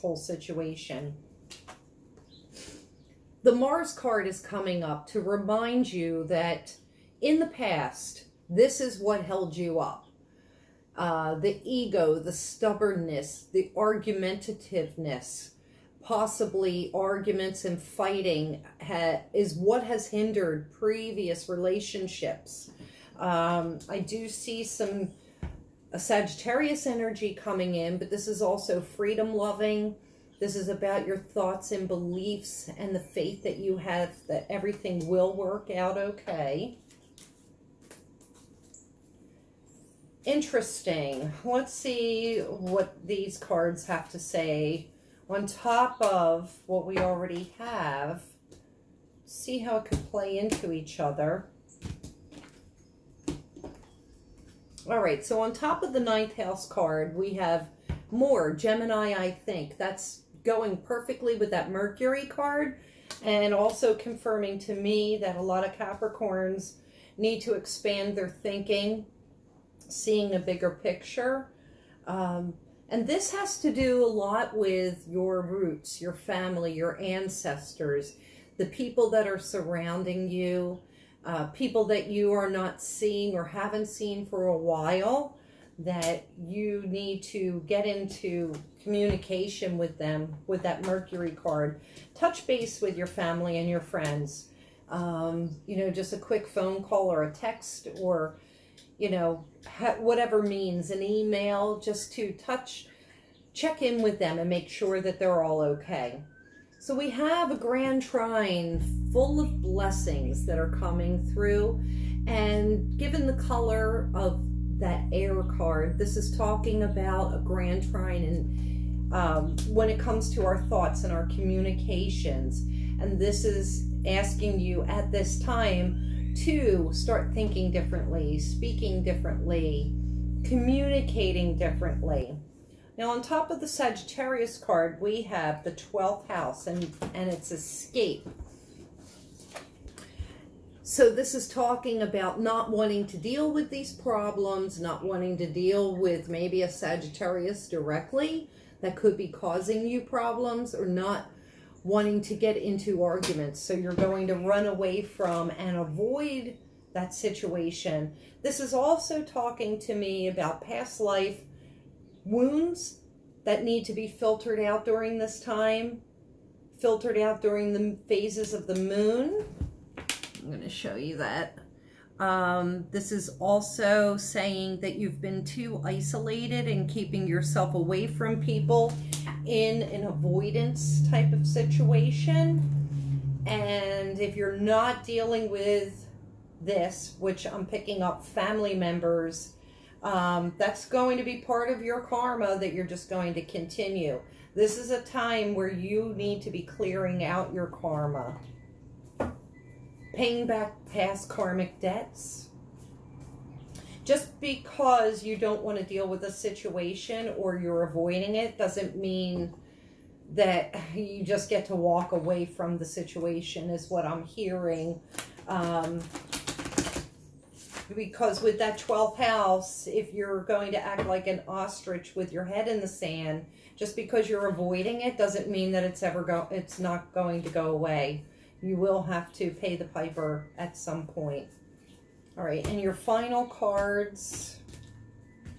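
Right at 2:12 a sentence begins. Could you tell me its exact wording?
Now, on top of the Sagittarius card, we have the 12th house, and, and it's escape.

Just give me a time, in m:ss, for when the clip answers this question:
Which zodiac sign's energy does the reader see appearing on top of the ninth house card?
0:58.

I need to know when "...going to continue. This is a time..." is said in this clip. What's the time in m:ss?
3:13.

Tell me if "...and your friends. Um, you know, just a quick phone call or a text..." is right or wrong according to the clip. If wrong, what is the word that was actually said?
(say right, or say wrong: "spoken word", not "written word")
right.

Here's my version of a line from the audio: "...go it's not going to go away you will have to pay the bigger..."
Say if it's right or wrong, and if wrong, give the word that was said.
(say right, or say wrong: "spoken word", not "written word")
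wrong: "piper", not "bigger".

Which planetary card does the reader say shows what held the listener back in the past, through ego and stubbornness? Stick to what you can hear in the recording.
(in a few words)
Mars.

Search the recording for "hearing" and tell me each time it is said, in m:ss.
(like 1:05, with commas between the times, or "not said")
3:34.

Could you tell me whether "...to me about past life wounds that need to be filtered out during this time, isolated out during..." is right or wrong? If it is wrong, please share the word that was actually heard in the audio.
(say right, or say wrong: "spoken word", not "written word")
wrong: "filtered", not "isolated".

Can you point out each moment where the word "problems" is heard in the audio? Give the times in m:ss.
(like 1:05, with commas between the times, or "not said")
2:23, 2:30.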